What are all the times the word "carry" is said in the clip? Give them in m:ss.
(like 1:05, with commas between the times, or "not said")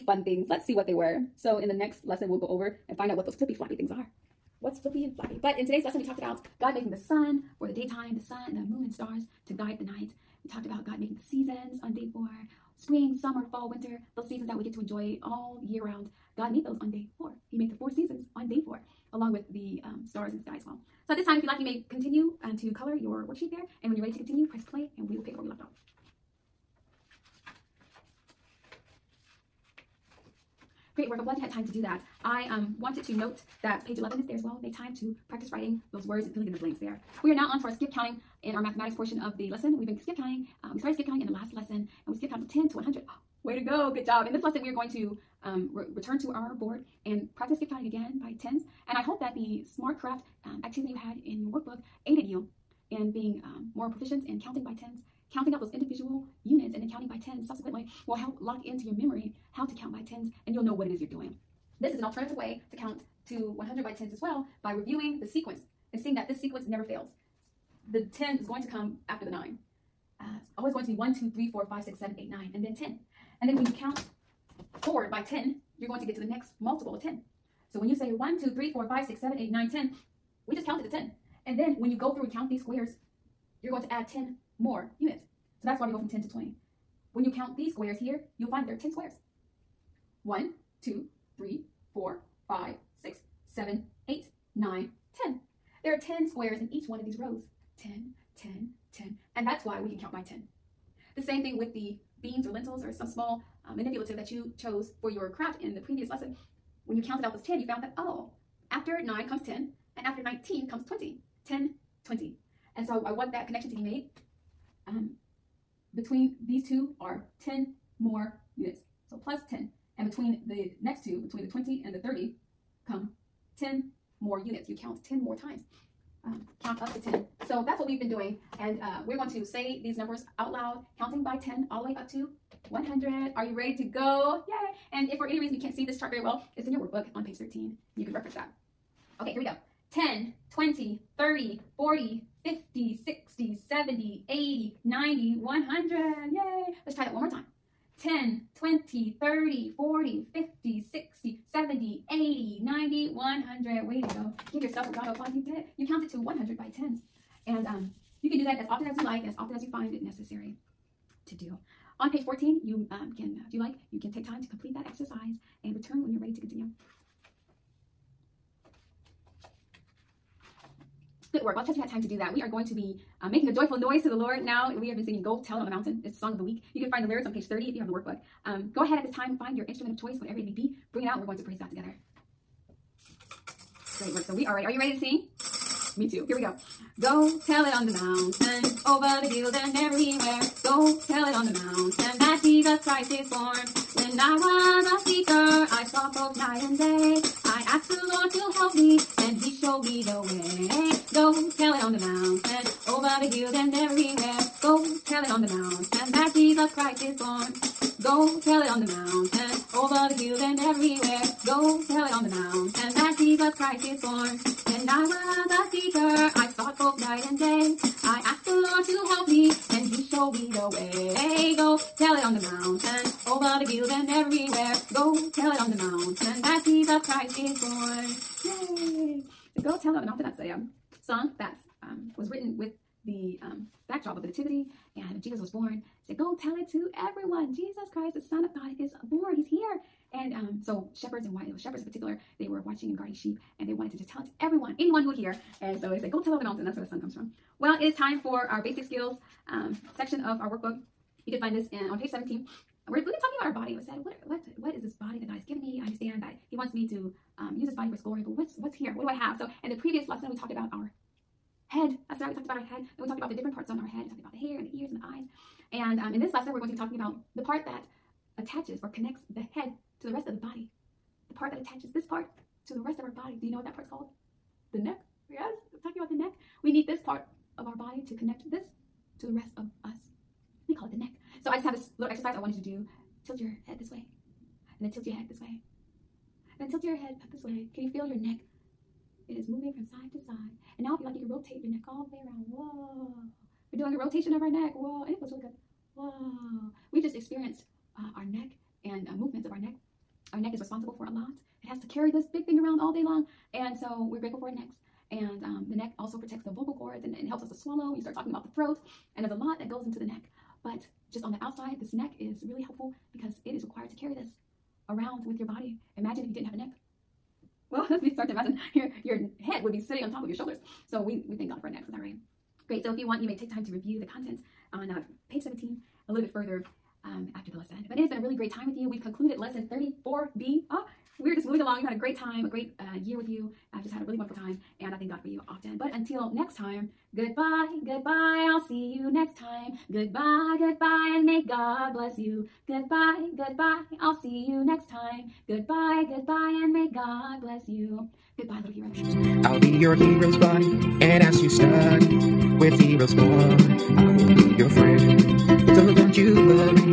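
5:01, 5:13.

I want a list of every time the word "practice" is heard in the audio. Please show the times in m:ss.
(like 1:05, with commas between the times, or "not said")
0:35, 0:47.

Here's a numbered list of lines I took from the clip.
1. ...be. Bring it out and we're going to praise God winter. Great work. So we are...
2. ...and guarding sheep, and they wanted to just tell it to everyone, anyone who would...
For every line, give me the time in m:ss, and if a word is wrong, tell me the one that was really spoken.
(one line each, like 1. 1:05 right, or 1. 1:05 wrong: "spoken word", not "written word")
1. 3:00 wrong: "together", not "winter"
2. 4:02 right.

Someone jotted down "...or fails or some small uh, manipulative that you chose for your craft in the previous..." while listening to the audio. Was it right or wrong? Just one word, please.
wrong.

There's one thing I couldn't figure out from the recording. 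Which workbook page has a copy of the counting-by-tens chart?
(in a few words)
13.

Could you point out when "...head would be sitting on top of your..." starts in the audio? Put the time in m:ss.
5:19.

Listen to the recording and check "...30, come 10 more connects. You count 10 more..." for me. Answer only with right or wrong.
wrong.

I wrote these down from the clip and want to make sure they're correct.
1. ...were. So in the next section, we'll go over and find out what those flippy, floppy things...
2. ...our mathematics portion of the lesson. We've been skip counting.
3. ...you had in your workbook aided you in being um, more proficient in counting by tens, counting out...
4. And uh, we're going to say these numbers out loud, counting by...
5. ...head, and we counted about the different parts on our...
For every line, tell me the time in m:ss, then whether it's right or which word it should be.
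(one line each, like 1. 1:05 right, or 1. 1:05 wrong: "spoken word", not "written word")
1. 0:00 wrong: "lesson", not "section"
2. 0:38 right
3. 0:50 right
4. 2:08 right
5. 4:22 wrong: "talked", not "counted".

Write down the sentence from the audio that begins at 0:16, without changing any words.
God made those on day four.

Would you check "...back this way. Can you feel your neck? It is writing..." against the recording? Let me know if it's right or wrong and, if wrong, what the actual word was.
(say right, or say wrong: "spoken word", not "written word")
wrong: "moving", not "writing".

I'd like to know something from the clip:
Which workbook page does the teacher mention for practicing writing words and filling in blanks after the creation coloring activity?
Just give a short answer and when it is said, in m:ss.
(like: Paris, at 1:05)
11, at 0:33.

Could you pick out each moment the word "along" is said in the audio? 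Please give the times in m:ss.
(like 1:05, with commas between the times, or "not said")
0:19, 5:31.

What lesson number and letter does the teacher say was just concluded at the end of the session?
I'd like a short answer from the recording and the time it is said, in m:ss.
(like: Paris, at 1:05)
34B, at 5:29.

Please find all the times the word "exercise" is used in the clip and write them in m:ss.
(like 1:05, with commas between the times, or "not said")
2:44, 4:42.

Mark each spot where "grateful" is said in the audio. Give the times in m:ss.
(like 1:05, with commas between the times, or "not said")
5:04.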